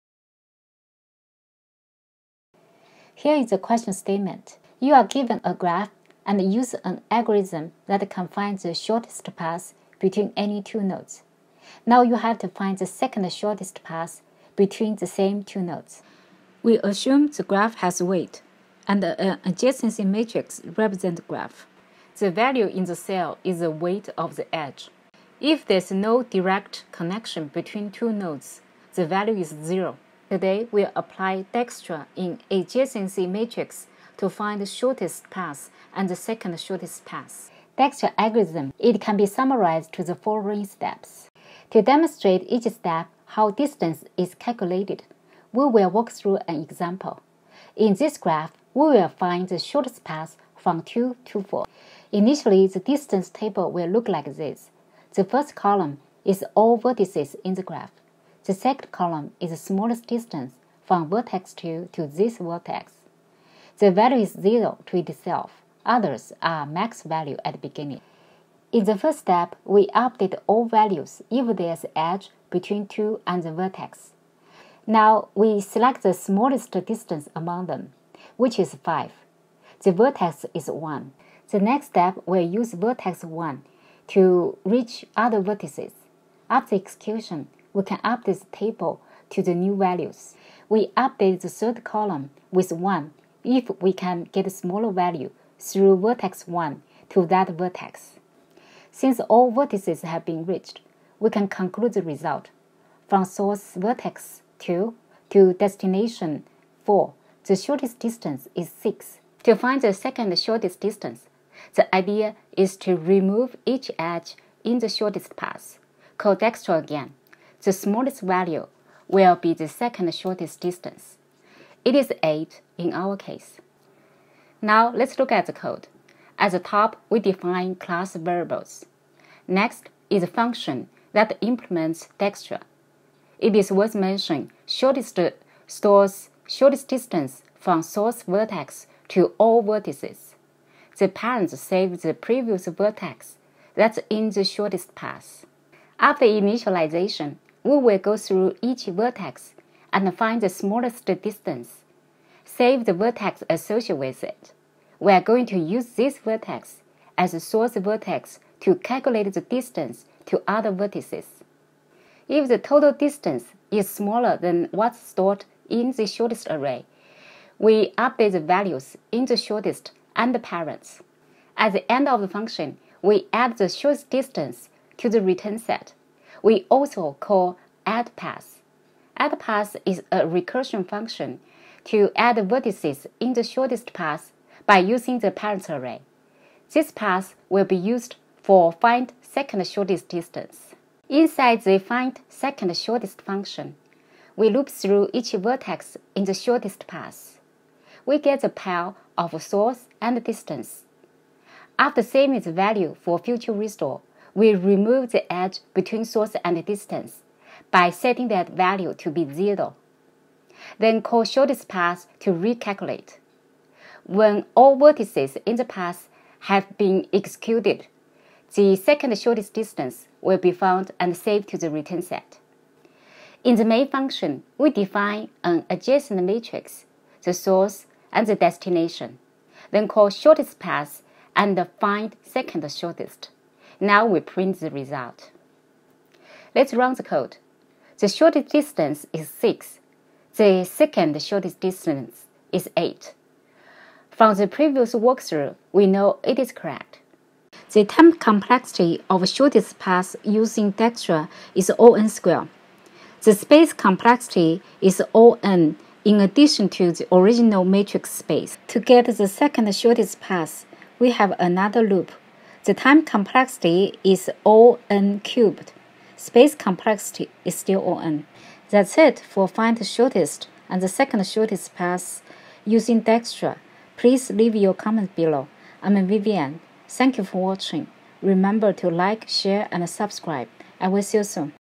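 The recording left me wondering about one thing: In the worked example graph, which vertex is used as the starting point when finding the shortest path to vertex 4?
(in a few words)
2.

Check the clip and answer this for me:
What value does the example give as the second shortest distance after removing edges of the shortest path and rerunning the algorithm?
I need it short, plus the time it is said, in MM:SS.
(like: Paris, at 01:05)
8, at 02:01.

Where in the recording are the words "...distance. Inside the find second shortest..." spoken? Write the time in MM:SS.
03:10.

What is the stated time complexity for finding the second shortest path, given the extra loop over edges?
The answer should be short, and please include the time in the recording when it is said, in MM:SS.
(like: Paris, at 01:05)
O(n^3), at 04:24.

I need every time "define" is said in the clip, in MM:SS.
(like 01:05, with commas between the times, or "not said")
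02:07, 03:44.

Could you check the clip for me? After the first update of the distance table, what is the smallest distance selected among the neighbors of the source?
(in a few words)
5.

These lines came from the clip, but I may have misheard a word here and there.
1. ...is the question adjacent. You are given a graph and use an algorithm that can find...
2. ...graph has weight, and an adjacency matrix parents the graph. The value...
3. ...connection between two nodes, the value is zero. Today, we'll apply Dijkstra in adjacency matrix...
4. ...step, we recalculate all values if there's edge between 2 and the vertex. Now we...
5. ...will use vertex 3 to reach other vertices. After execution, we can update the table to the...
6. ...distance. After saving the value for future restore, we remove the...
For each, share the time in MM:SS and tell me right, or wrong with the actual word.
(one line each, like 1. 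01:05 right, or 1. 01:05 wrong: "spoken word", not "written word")
1. 00:03 wrong: "statement", not "adjacent"
2. 00:17 wrong: "represents", not "parents"
3. 00:26 right
4. 01:09 wrong: "update", not "recalculate"
5. 01:22 wrong: "1", not "3"
6. 03:20 right.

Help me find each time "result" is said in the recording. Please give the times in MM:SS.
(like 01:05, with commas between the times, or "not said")
01:42, 03:54.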